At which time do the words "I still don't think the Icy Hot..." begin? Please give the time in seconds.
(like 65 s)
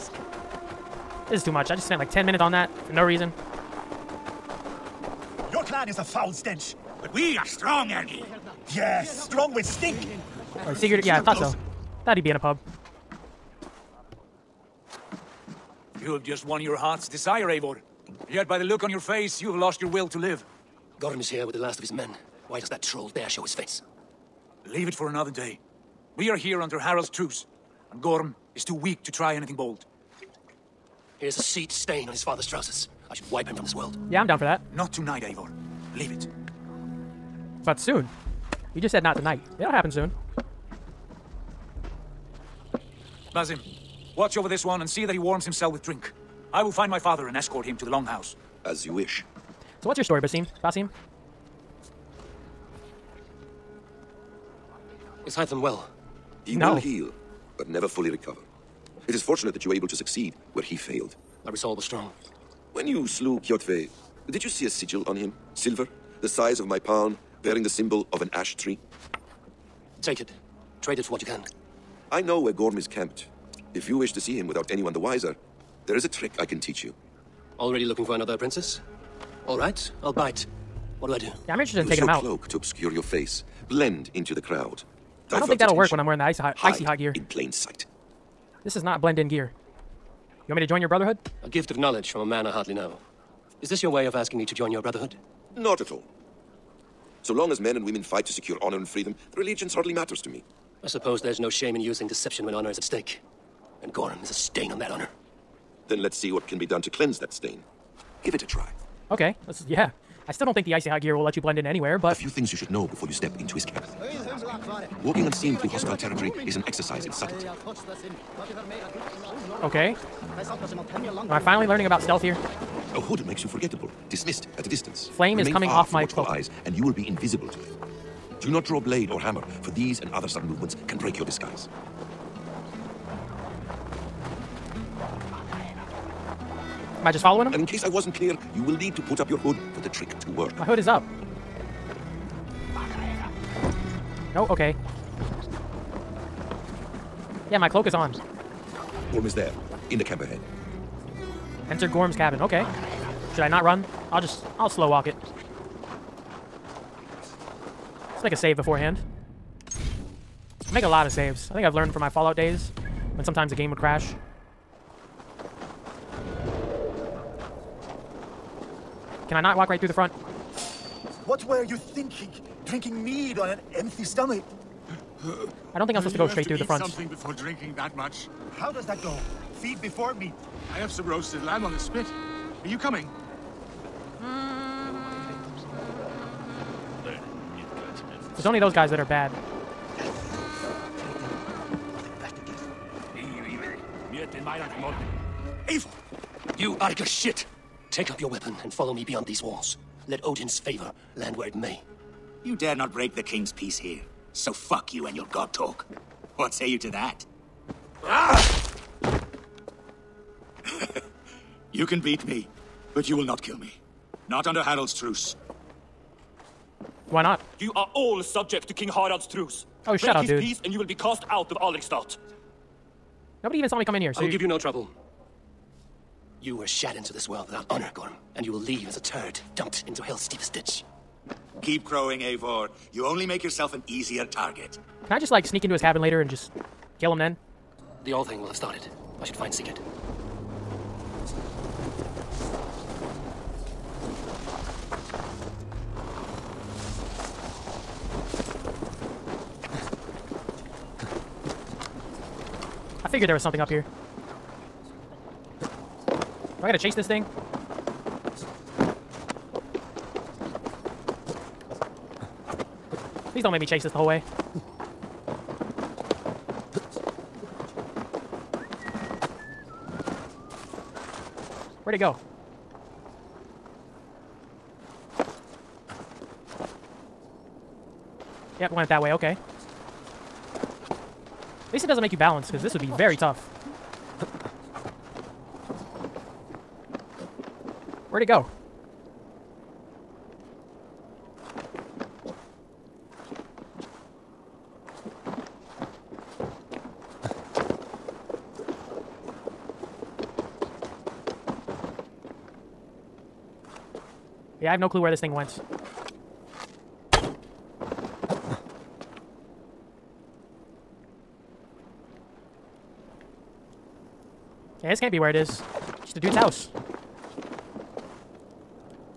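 110 s.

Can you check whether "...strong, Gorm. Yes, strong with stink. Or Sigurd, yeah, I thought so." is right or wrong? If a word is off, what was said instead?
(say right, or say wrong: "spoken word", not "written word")
wrong: "Ergi", not "Gorm".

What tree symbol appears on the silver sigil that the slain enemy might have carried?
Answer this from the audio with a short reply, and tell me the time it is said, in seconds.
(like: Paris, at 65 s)
ash tree, at 68 s.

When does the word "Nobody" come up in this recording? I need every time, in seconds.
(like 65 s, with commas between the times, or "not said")
223 s.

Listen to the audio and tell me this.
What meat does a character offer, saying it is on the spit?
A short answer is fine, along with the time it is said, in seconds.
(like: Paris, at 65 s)
roasted lamb, at 181 s.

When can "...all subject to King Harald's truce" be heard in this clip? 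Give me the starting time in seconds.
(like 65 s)
217 s.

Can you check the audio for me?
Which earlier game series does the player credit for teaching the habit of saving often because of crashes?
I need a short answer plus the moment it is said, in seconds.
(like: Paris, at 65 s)
Fallout, at 162 s.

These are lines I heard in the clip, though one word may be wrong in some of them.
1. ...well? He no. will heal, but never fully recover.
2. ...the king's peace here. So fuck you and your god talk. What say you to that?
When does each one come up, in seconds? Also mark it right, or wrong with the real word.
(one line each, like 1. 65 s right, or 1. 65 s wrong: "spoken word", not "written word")
1. 55 s right
2. 203 s right.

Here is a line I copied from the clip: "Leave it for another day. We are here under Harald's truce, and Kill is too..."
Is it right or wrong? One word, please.
wrong.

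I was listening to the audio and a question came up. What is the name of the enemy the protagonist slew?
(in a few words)
Kjotve.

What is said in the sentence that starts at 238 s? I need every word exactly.
The old thing will have started.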